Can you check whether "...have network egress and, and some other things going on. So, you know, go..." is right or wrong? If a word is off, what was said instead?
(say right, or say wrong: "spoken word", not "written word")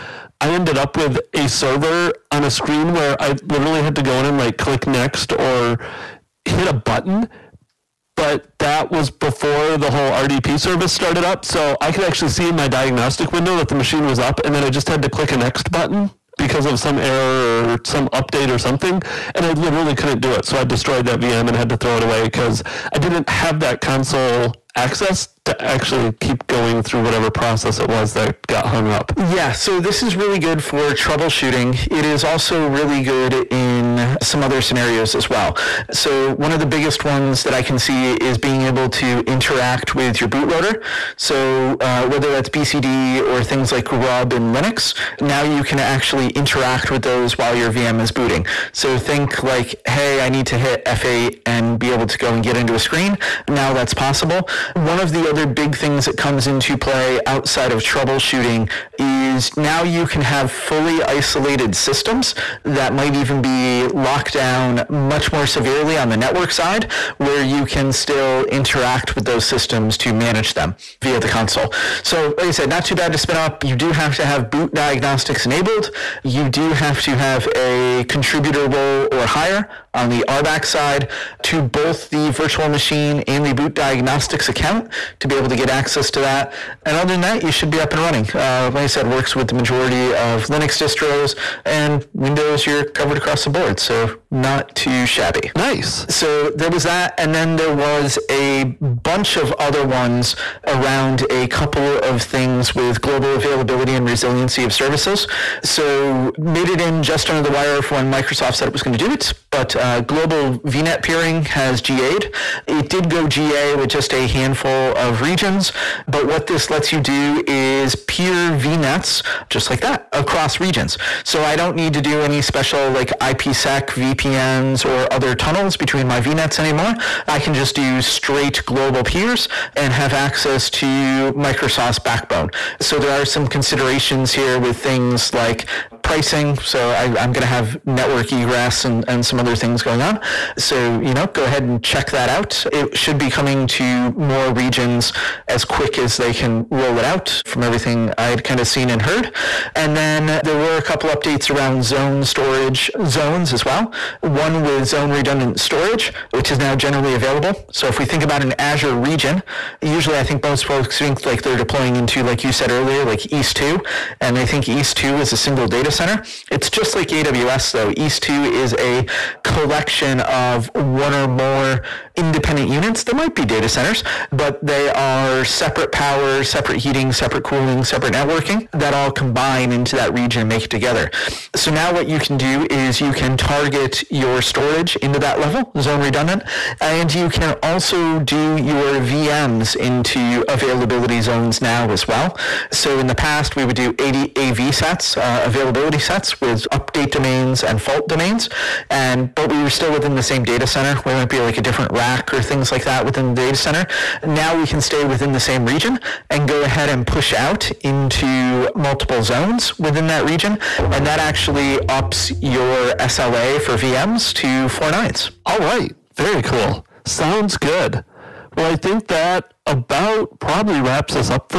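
right.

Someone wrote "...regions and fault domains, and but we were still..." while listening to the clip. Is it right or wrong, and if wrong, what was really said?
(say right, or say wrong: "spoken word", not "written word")
wrong: "domains", not "regions".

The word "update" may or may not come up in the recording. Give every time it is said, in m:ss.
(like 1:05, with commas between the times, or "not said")
0:18, 2:31, 3:16.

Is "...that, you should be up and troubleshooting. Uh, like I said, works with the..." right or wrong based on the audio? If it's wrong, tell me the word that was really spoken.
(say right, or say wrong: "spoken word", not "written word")
wrong: "running", not "troubleshooting".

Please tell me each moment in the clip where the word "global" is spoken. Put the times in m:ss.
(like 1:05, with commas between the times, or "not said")
1:42, 1:50, 2:08.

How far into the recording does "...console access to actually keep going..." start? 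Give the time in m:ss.
0:23.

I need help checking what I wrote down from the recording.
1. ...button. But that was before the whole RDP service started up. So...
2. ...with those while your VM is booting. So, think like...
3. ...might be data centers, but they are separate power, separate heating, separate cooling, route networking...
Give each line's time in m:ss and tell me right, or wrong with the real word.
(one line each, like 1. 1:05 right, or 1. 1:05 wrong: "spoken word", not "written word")
1. 0:06 right
2. 0:46 right
3. 2:53 wrong: "separate", not "route".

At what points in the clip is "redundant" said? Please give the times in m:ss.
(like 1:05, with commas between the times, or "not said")
2:35, 3:05.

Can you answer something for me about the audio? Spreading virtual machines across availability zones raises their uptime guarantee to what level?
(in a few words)
Four nines.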